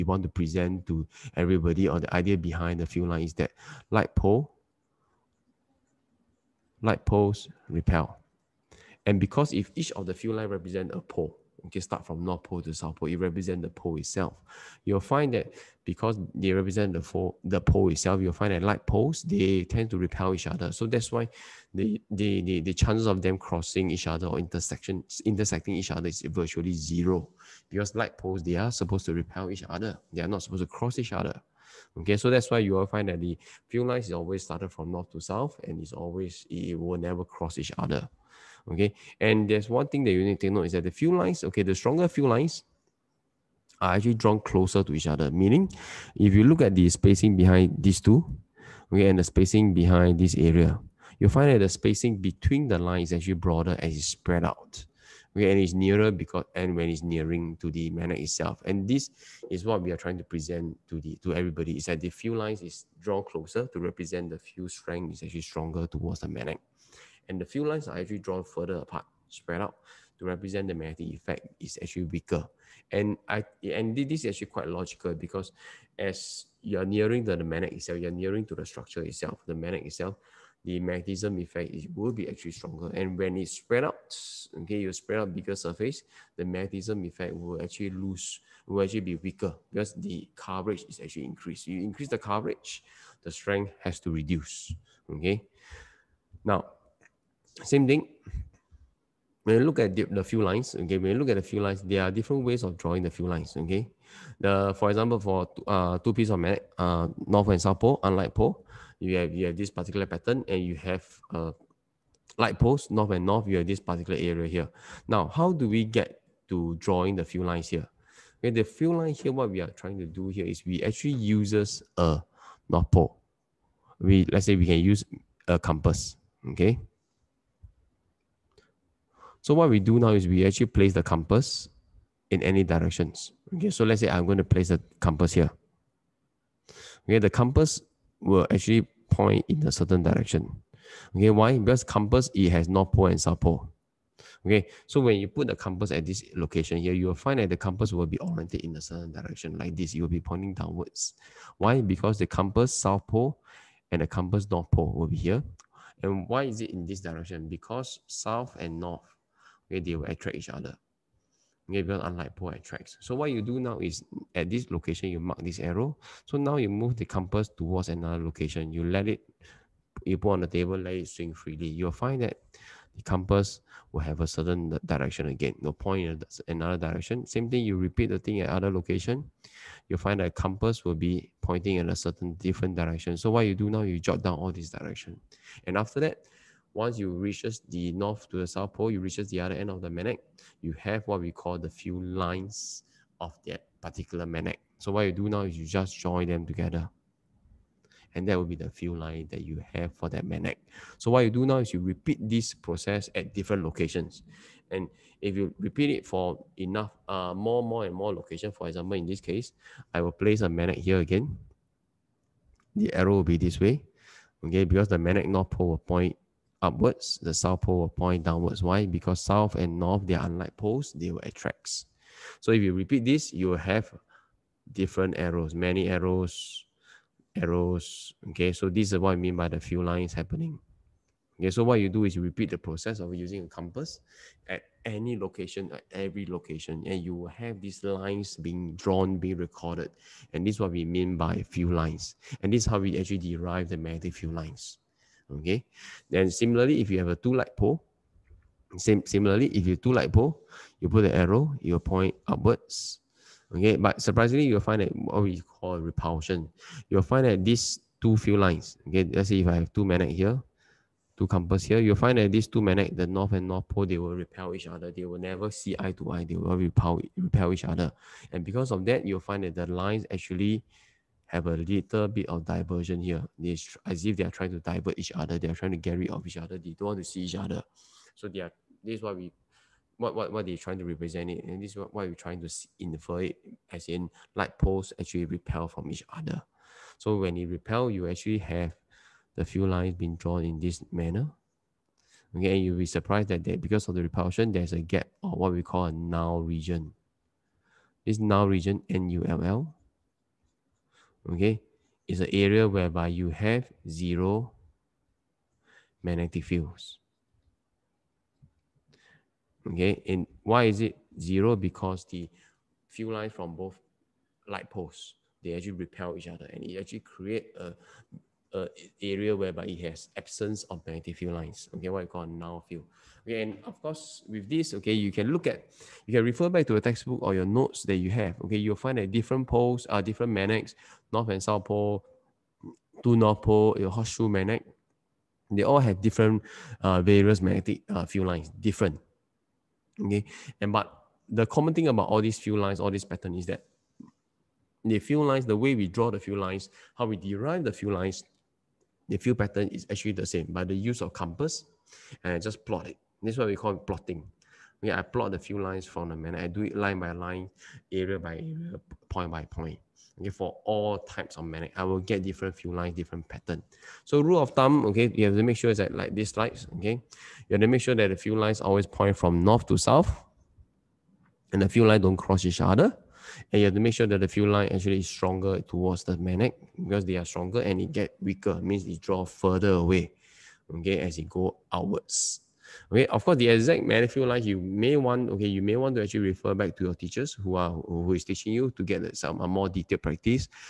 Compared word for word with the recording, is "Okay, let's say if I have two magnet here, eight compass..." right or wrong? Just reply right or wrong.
wrong.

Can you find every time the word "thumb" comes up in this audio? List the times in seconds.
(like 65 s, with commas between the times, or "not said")
364 s.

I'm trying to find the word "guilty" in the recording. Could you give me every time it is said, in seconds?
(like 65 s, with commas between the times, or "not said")
not said.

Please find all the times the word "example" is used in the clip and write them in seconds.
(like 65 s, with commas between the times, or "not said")
104 s, 208 s.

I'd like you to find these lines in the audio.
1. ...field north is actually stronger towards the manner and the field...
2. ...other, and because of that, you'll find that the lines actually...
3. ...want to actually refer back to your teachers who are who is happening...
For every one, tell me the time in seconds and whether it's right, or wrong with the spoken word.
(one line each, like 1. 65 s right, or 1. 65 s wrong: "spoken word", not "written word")
1. 64 s wrong: "strength", not "north"
2. 267 s right
3. 385 s wrong: "teaching", not "happening".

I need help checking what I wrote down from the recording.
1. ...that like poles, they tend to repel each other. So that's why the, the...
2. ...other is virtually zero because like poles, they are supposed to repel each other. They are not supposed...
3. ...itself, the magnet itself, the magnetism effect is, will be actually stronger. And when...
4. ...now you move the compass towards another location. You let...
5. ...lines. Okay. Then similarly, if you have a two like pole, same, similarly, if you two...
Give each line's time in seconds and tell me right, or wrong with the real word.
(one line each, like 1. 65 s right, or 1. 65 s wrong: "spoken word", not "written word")
1. 18 s right
2. 25 s right
3. 79 s right
4. 166 s right
5. 244 s right.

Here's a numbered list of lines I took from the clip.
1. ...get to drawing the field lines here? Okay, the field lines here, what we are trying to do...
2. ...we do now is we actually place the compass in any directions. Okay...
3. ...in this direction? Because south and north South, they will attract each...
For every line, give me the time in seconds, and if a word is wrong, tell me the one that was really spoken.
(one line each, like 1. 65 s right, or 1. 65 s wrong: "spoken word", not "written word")
1. 115 s right
2. 129 s right
3. 156 s wrong: "Okay", not "South".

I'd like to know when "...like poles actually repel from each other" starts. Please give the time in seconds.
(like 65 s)
284 s.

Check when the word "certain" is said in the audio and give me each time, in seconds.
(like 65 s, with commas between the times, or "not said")
139 s, 148 s, 174 s, 181 s.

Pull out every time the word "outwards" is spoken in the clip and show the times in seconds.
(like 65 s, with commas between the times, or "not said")
381 s.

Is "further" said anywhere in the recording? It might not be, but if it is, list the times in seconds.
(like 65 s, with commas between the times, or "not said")
68 s, 379 s.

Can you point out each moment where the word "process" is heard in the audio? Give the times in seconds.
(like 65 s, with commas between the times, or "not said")
202 s, 232 s.